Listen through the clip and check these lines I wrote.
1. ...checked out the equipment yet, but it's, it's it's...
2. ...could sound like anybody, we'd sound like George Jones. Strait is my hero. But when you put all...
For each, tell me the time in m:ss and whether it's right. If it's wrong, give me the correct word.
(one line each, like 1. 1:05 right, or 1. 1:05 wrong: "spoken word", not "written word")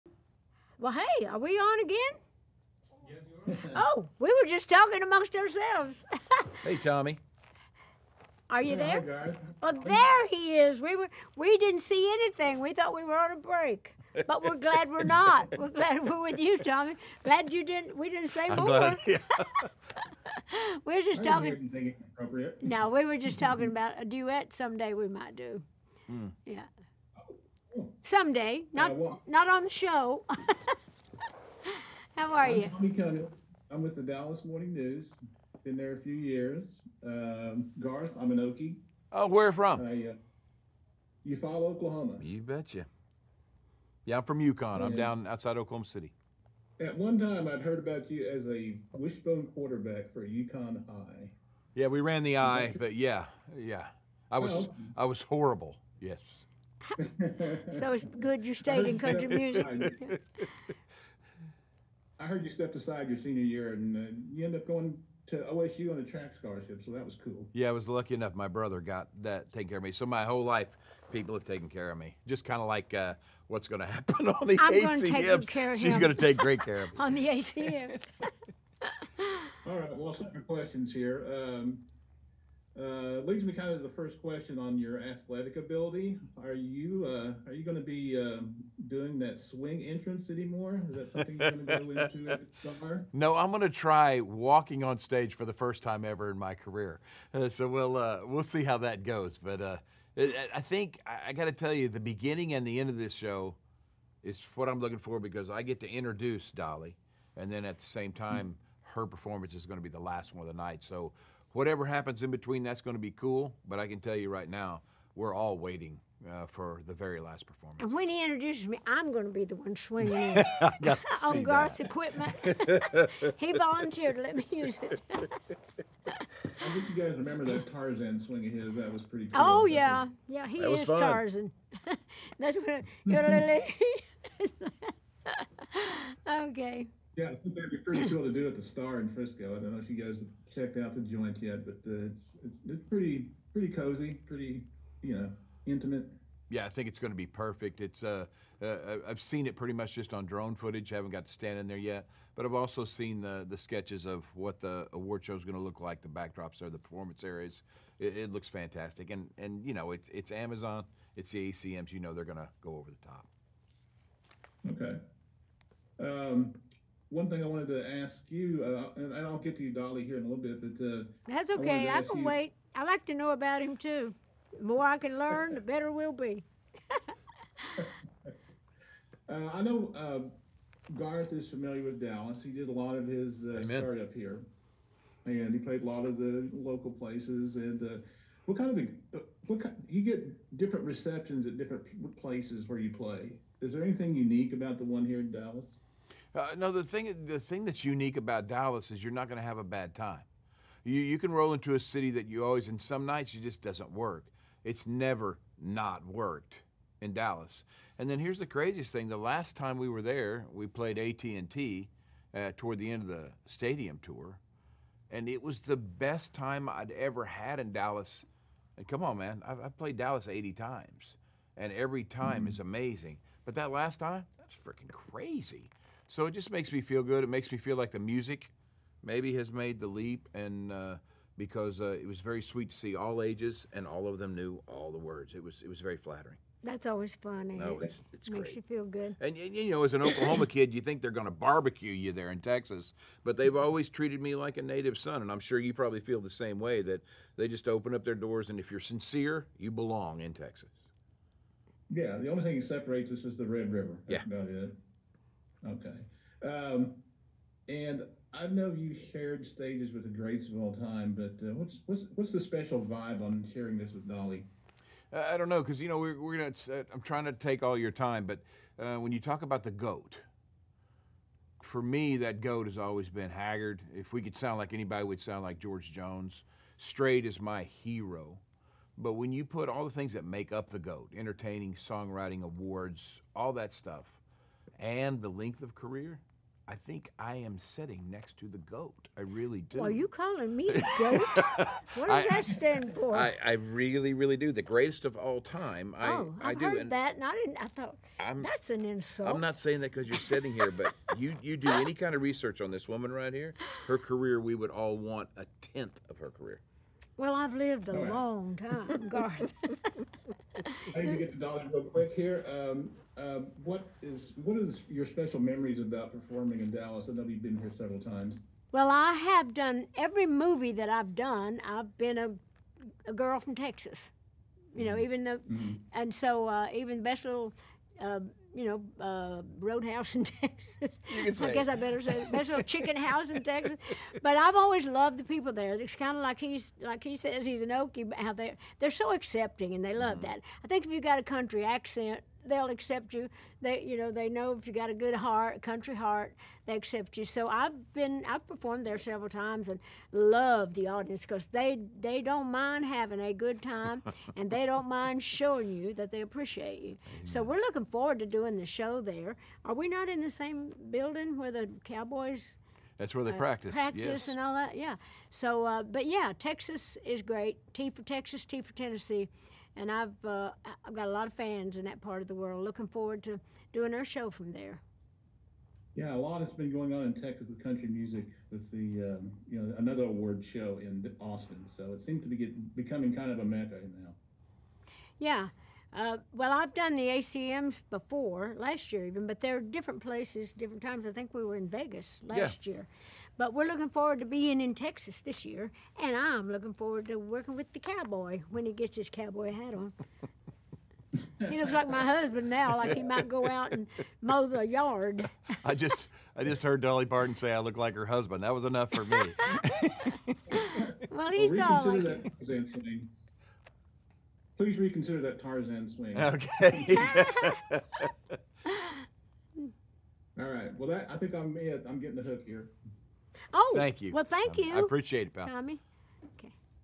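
1. 2:20 wrong: "joint", not "equipment"
2. 4:34 right.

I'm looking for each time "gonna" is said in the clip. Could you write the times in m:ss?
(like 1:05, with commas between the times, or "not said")
4:26.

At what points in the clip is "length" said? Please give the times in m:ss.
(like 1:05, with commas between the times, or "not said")
4:45.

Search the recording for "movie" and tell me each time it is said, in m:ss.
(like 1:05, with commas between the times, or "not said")
5:20.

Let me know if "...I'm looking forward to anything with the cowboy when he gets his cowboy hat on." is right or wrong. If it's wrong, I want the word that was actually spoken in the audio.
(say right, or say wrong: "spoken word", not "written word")
wrong: "working", not "anything".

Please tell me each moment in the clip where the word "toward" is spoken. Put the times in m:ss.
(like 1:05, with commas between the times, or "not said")
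3:32.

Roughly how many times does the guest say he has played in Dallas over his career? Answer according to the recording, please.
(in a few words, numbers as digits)
80.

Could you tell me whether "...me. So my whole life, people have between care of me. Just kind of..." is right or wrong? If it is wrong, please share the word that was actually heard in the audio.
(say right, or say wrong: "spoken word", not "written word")
wrong: "taken", not "between".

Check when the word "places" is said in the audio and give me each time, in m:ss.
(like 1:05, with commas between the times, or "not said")
3:06, 3:12, 6:30.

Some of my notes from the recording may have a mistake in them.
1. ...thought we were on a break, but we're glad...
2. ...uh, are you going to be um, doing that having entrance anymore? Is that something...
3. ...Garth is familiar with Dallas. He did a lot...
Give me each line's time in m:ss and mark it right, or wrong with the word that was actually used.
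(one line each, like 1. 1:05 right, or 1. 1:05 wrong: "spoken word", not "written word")
1. 0:12 right
2. 1:27 wrong: "swing", not "having"
3. 3:00 right.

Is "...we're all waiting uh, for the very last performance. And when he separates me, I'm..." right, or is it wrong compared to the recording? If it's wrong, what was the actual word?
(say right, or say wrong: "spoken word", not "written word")
wrong: "introduces", not "separates".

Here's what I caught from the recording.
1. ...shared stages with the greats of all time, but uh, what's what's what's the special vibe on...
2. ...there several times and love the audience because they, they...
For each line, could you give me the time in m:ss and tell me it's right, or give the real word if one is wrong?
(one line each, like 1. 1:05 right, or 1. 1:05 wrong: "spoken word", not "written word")
1. 4:19 right
2. 5:48 right.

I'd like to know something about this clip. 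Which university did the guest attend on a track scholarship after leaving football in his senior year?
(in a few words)
OSU.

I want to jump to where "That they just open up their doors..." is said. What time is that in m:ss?
4:06.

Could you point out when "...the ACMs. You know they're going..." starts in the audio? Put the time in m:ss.
2:41.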